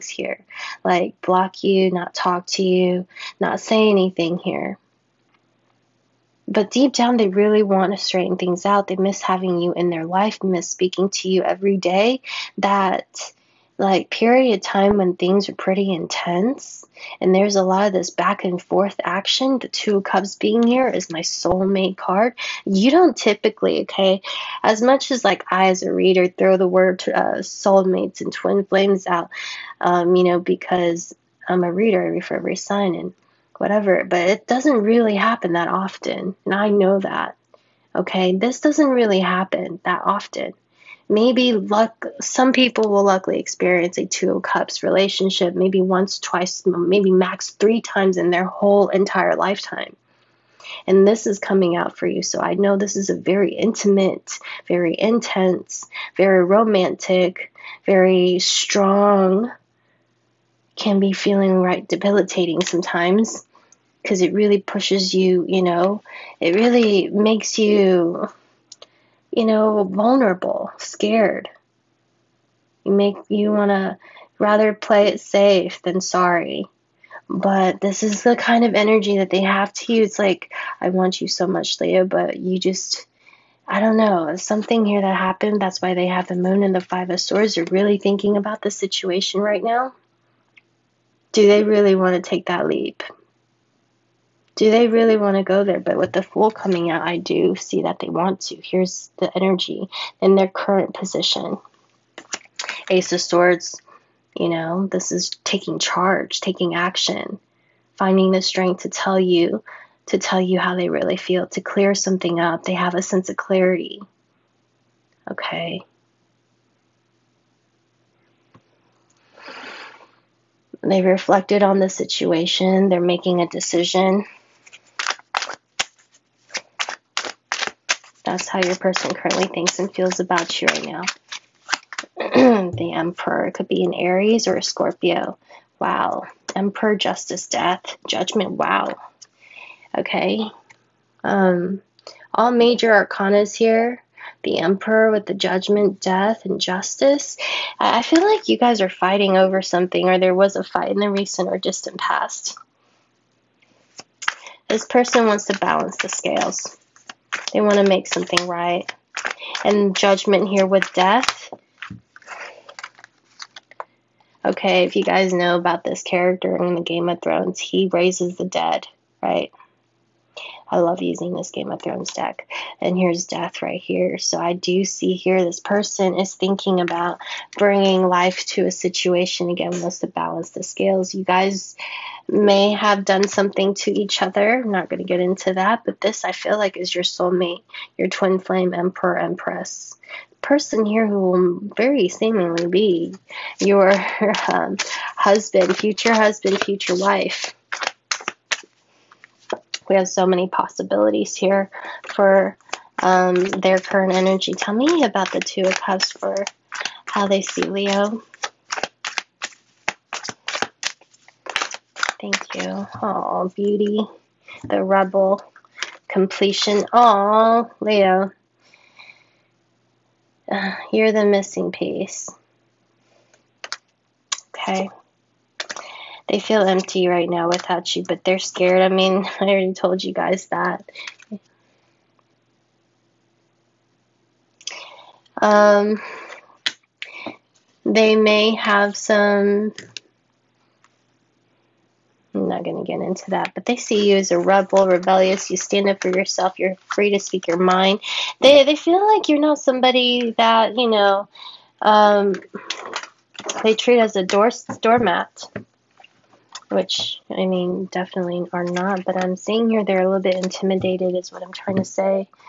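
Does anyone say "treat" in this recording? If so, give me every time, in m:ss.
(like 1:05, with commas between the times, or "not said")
4:13.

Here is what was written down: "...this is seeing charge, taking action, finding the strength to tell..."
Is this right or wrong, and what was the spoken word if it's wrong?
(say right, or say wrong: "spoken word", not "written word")
wrong: "taking", not "seeing".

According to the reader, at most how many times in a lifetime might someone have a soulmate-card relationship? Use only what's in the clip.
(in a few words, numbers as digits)
3.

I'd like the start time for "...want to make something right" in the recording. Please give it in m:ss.
2:37.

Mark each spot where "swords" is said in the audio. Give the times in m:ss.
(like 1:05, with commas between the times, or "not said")
1:27, 1:43.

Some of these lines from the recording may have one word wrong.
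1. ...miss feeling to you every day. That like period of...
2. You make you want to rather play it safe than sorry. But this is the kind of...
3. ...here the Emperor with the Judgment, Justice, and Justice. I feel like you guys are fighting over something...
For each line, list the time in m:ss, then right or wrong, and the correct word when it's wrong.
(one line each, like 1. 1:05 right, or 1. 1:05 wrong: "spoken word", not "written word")
1. 0:10 wrong: "speaking", not "feeling"
2. 1:12 right
3. 2:23 wrong: "Death", not "Justice".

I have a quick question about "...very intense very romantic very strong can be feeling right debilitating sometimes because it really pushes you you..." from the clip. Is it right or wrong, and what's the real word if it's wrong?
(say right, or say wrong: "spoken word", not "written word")
right.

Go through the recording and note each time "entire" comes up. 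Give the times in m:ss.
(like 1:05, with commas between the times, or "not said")
0:48.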